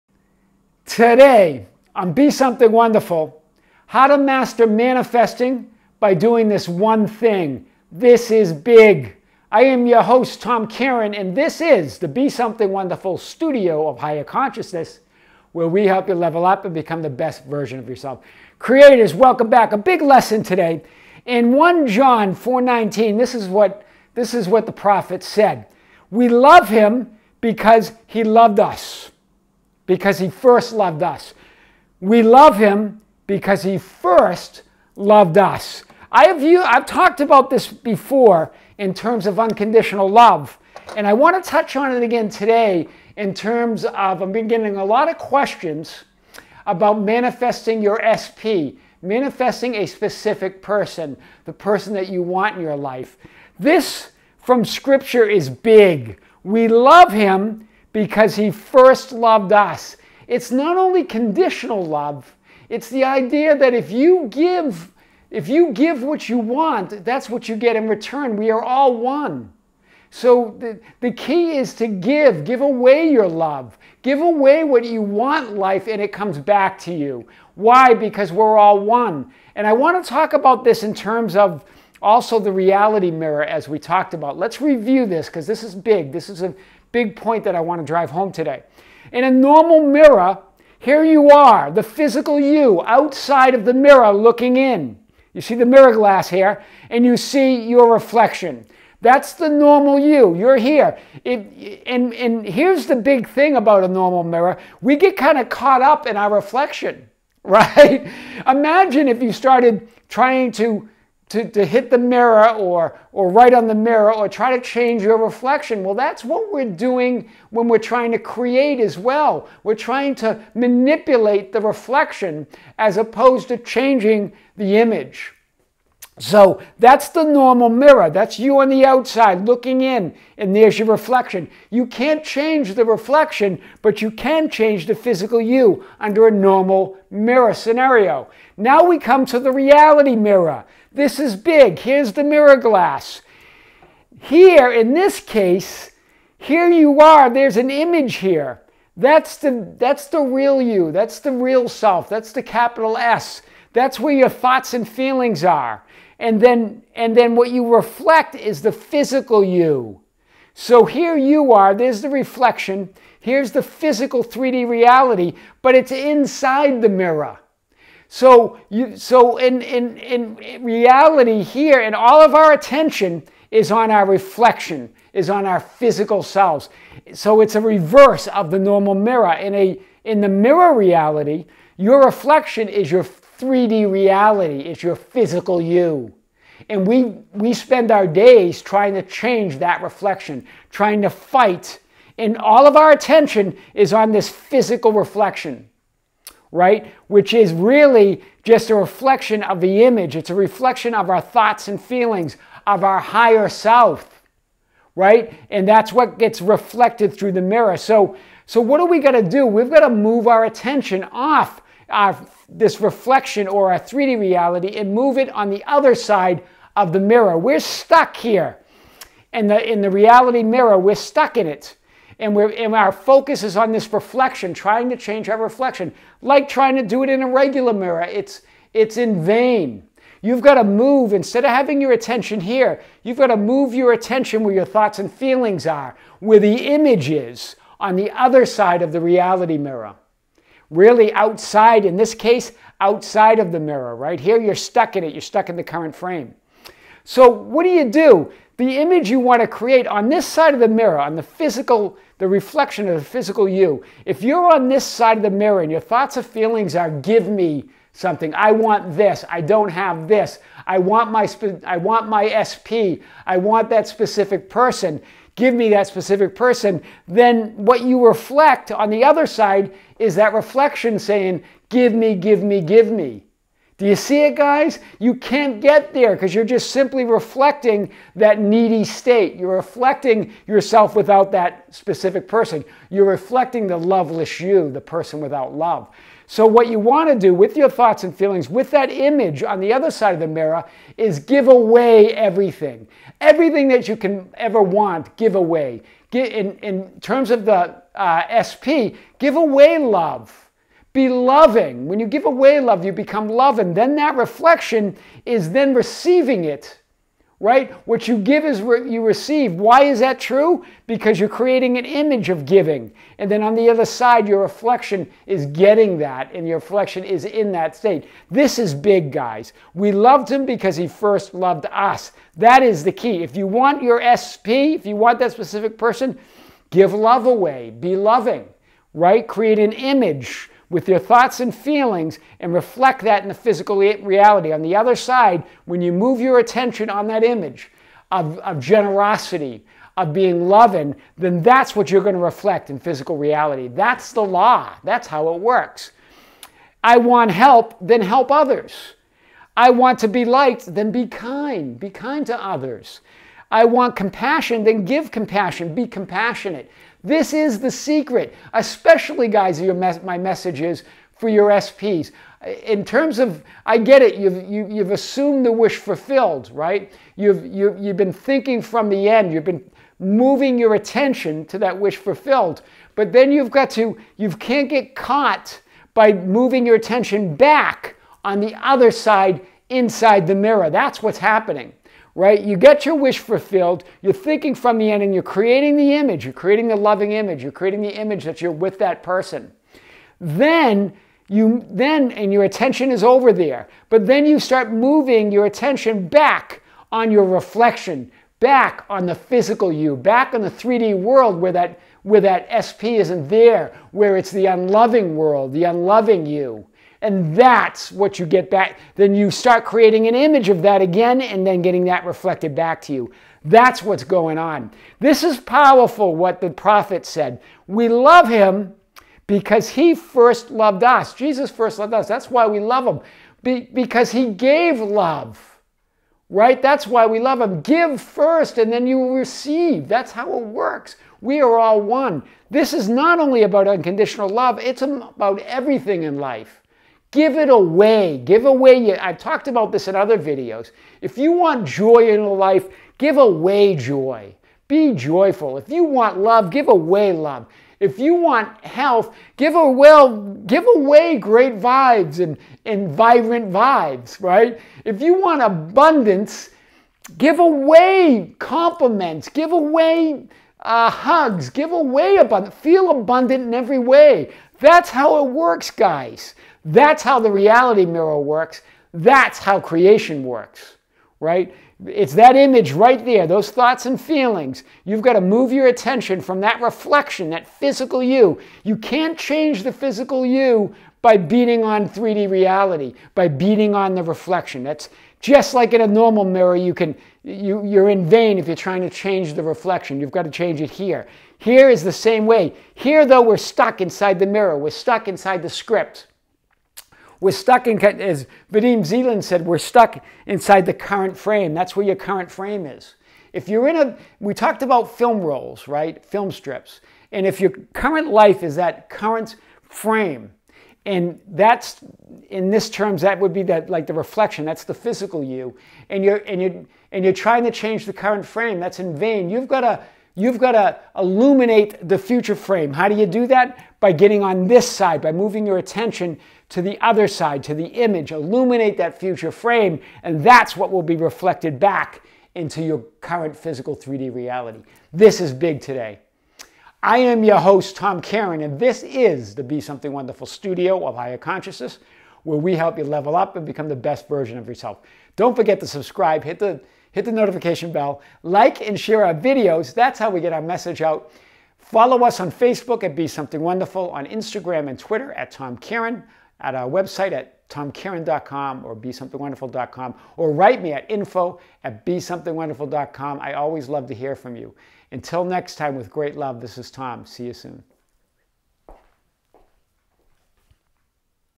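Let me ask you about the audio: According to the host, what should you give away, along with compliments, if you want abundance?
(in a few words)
Hugs.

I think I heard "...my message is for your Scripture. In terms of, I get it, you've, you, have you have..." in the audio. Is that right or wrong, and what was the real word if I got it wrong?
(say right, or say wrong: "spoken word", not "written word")
wrong: "SPs", not "Scripture".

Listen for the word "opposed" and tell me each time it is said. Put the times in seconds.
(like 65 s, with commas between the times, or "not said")
122 s.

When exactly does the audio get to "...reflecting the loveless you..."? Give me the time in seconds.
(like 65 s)
283 s.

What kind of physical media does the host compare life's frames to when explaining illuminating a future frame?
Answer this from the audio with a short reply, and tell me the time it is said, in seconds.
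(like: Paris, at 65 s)
Film strips, at 506 s.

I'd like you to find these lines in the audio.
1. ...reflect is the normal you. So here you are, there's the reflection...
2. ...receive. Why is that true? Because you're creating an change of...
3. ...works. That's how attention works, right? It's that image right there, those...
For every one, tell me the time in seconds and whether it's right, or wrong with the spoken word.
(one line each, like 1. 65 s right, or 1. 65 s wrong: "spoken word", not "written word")
1. 157 s wrong: "physical", not "normal"
2. 309 s wrong: "image", not "change"
3. 468 s wrong: "creation", not "attention".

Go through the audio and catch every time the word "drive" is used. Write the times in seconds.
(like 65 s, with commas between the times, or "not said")
87 s.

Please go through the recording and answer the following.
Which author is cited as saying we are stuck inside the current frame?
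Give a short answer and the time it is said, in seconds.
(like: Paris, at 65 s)
Vadim Zeland, at 498 s.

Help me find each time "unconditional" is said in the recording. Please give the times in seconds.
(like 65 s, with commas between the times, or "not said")
39 s, 433 s.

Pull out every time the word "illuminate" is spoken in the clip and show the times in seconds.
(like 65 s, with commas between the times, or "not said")
520 s, 528 s.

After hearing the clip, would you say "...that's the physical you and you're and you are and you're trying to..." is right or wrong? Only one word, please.
right.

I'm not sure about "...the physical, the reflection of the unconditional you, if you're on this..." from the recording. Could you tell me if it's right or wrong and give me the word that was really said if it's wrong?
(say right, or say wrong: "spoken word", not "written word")
wrong: "physical", not "unconditional".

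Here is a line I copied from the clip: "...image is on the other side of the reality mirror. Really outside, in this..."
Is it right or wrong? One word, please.
right.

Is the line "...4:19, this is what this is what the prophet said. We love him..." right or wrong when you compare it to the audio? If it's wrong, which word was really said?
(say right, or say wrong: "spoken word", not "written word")
right.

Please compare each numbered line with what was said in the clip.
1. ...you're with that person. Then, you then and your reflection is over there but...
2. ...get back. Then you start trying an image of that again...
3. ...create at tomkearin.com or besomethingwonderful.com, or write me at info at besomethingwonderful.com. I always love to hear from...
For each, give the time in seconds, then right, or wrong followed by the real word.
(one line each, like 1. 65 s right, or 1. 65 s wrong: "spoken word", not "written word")
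1. 388 s wrong: "attention", not "reflection"
2. 408 s wrong: "creating", not "trying"
3. 556 s wrong: "website", not "create".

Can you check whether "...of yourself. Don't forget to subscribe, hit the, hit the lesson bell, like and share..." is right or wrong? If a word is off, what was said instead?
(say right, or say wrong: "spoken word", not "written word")
wrong: "notification", not "lesson".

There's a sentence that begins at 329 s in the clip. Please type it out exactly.
Create an image with your thoughts and feelings and reflect that in the physical reality.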